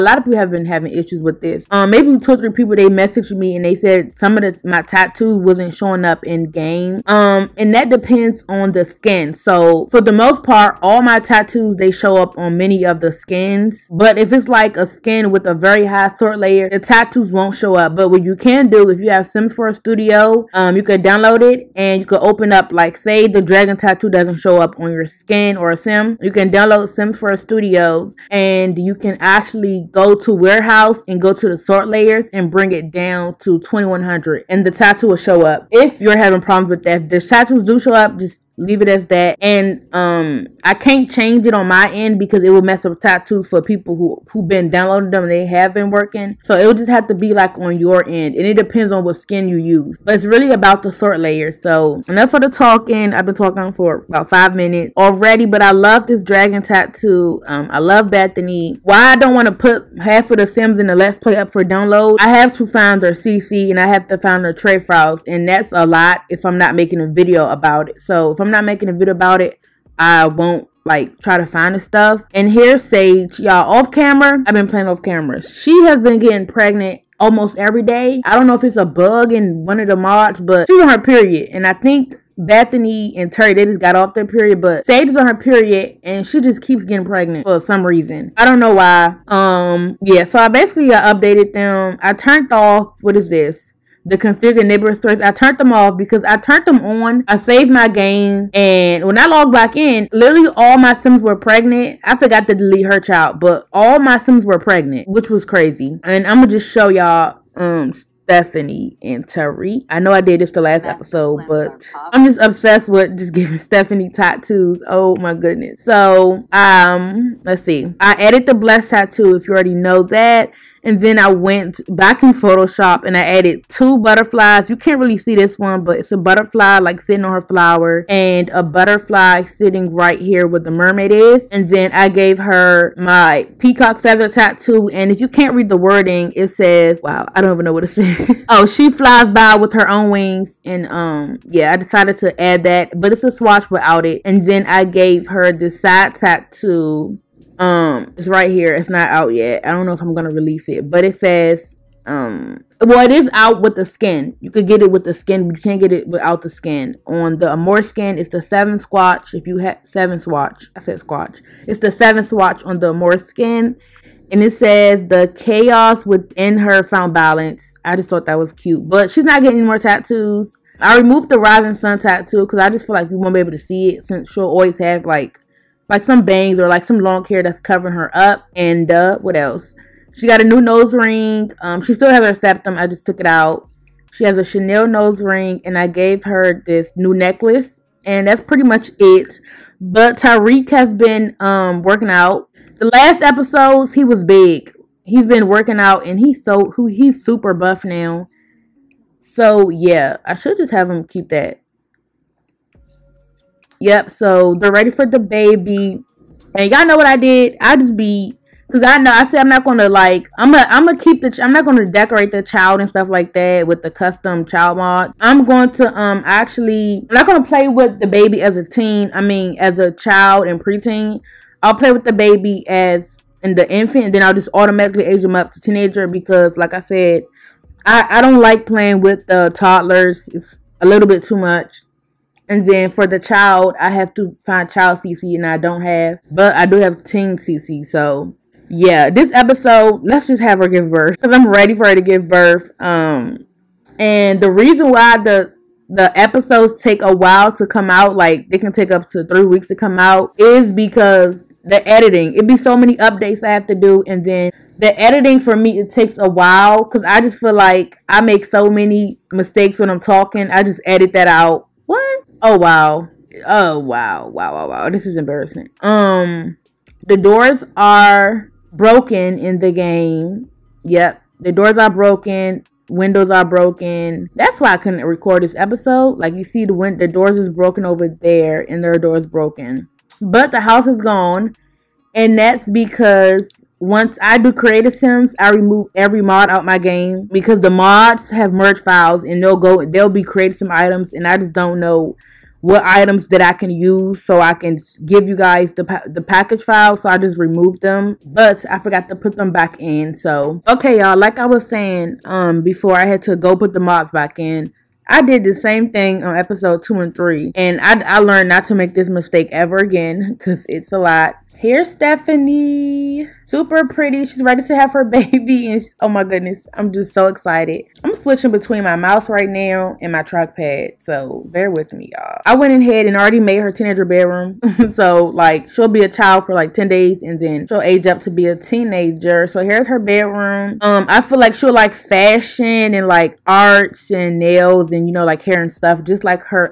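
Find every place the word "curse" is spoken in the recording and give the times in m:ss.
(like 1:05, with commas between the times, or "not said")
not said.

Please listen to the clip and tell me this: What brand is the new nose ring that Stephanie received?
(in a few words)
Chanel.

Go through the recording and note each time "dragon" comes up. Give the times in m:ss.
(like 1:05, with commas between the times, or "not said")
0:23, 0:56.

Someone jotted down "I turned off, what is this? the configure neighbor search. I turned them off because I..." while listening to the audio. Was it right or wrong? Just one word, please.
right.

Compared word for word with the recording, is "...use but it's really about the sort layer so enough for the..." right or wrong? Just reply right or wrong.
right.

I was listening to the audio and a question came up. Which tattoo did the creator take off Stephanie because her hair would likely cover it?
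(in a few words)
rising sun tattoo.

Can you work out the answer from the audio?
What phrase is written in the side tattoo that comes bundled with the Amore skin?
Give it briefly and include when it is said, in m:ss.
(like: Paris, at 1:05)
the chaos within her found balance, at 2:45.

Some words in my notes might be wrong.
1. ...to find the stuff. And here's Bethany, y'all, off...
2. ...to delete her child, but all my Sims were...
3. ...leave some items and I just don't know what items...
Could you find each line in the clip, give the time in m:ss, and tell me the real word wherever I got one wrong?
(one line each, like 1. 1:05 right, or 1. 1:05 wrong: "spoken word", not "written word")
1. 1:11 wrong: "Sage", not "Bethany"
2. 1:42 right
3. 4:50 wrong: "creative", not "leave".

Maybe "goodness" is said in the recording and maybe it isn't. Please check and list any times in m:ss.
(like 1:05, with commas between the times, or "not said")
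1:55, 5:16.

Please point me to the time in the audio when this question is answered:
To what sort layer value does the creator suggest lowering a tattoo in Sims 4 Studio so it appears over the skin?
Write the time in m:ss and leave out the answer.
0:33.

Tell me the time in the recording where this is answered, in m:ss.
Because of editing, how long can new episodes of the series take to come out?
4:09.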